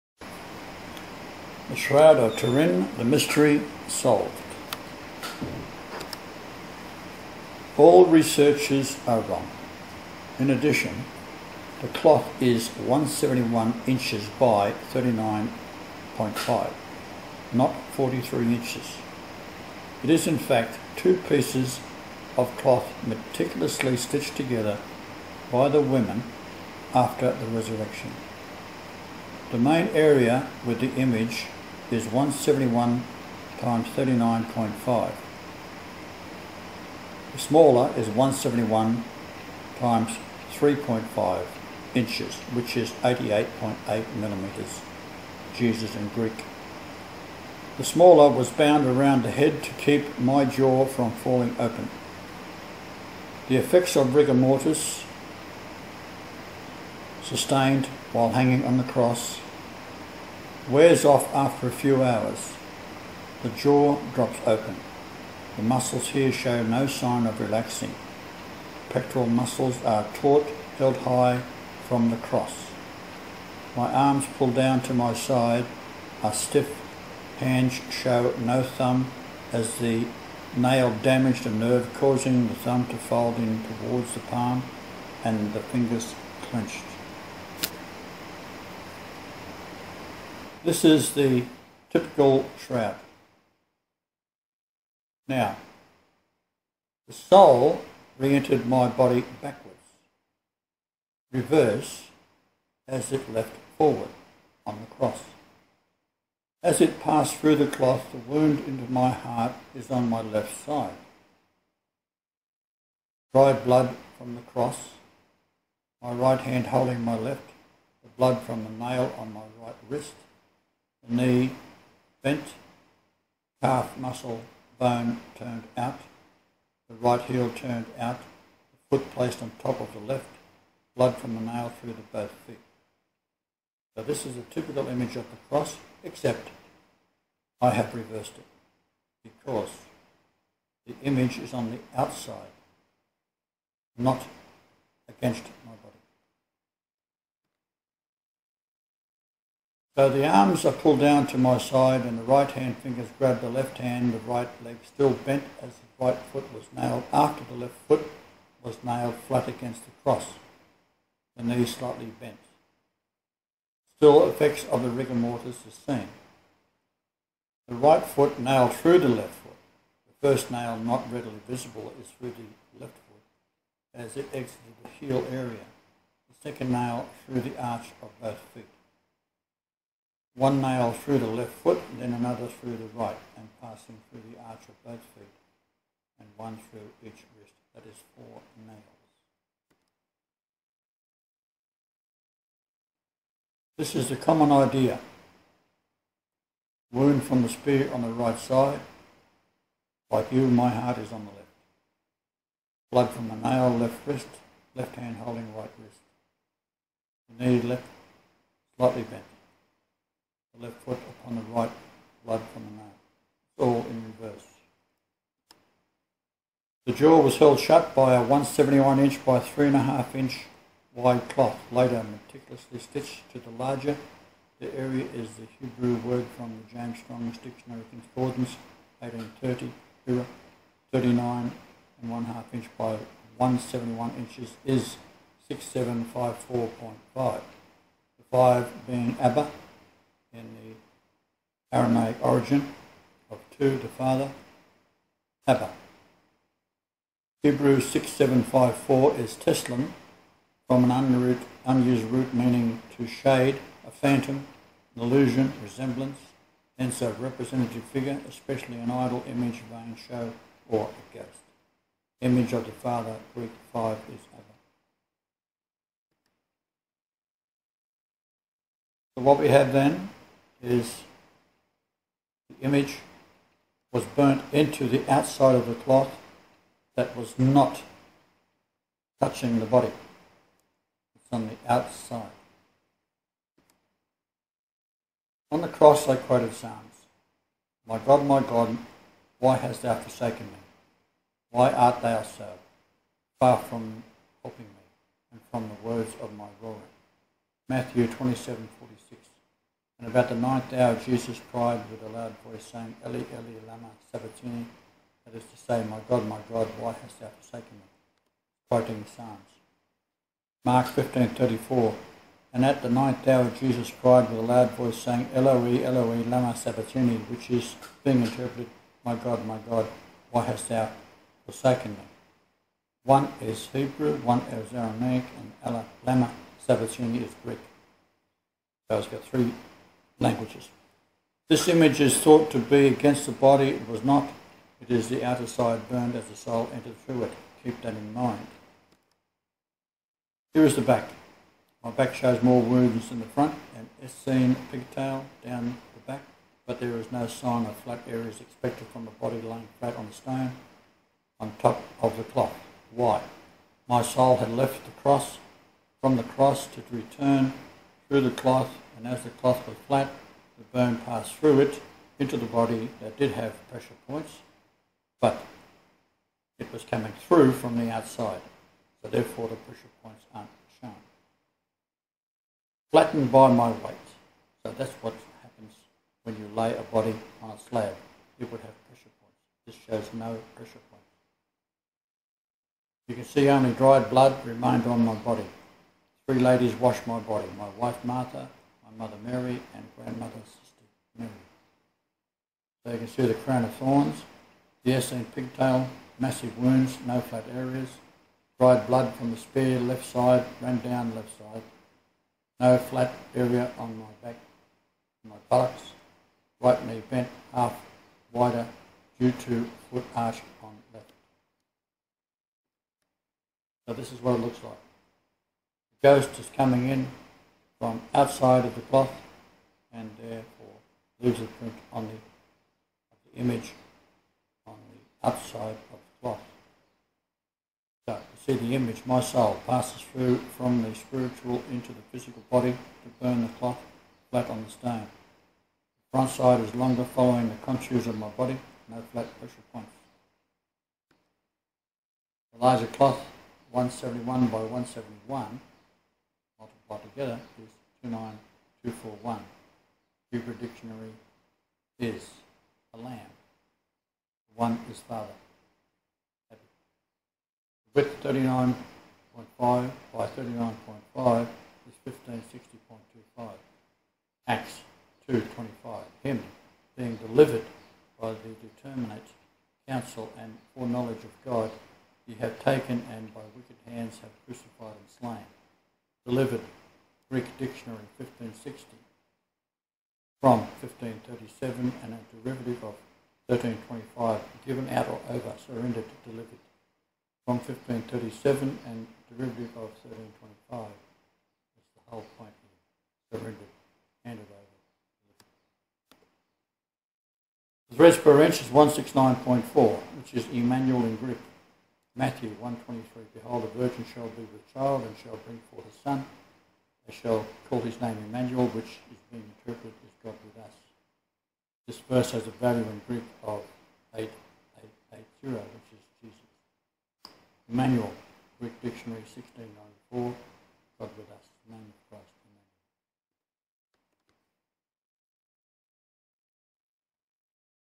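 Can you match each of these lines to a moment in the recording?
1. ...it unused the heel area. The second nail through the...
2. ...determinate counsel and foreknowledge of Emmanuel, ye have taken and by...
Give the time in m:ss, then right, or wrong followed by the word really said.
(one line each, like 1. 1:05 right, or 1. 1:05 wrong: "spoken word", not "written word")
1. 2:54 wrong: "exited", not "unused"
2. 7:48 wrong: "God", not "Emmanuel".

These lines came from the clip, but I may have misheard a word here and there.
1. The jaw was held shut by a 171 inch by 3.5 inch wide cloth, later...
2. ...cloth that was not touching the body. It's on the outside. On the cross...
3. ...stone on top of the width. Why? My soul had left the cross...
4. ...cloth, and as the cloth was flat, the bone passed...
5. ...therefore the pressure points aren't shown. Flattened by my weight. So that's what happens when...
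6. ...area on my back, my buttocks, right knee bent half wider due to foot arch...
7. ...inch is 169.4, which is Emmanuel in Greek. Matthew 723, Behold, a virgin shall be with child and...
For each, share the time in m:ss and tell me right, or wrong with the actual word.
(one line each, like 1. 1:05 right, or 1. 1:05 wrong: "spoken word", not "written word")
1. 3:36 right
2. 4:35 right
3. 5:50 wrong: "cloth", not "width"
4. 5:58 right
5. 6:09 right
6. 6:43 right
7. 8:18 wrong: "123", not "723".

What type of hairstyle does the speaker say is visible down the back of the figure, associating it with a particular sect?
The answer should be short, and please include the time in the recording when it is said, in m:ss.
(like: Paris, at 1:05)
Essene pigtail, at 6:34.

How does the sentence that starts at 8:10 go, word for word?
That's the whole point here, surrendered, handed over.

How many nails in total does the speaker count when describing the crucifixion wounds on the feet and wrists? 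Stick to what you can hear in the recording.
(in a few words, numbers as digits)
4.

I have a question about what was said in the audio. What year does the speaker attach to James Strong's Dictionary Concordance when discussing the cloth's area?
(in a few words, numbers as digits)
1830.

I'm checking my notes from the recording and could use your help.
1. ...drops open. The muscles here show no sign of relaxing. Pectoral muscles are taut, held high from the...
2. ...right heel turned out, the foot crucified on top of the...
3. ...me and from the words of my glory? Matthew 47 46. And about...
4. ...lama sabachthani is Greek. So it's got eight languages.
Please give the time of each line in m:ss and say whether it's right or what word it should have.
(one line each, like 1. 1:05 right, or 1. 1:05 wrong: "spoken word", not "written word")
1. 1:04 right
2. 2:06 wrong: "placed", not "crucified"
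3. 4:54 wrong: "27", not "47"
4. 5:26 wrong: "three", not "eight".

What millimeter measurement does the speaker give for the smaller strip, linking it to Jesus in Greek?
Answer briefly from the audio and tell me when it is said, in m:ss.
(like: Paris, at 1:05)
88.8 millimeters, at 0:43.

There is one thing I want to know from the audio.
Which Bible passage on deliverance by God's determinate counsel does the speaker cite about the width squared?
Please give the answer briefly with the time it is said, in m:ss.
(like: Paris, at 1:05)
Acts 2:25, at 7:44.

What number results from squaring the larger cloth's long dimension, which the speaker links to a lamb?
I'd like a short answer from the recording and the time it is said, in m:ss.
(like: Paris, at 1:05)
29241, at 7:28.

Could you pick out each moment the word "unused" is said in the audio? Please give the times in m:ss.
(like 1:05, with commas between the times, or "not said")
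4:11.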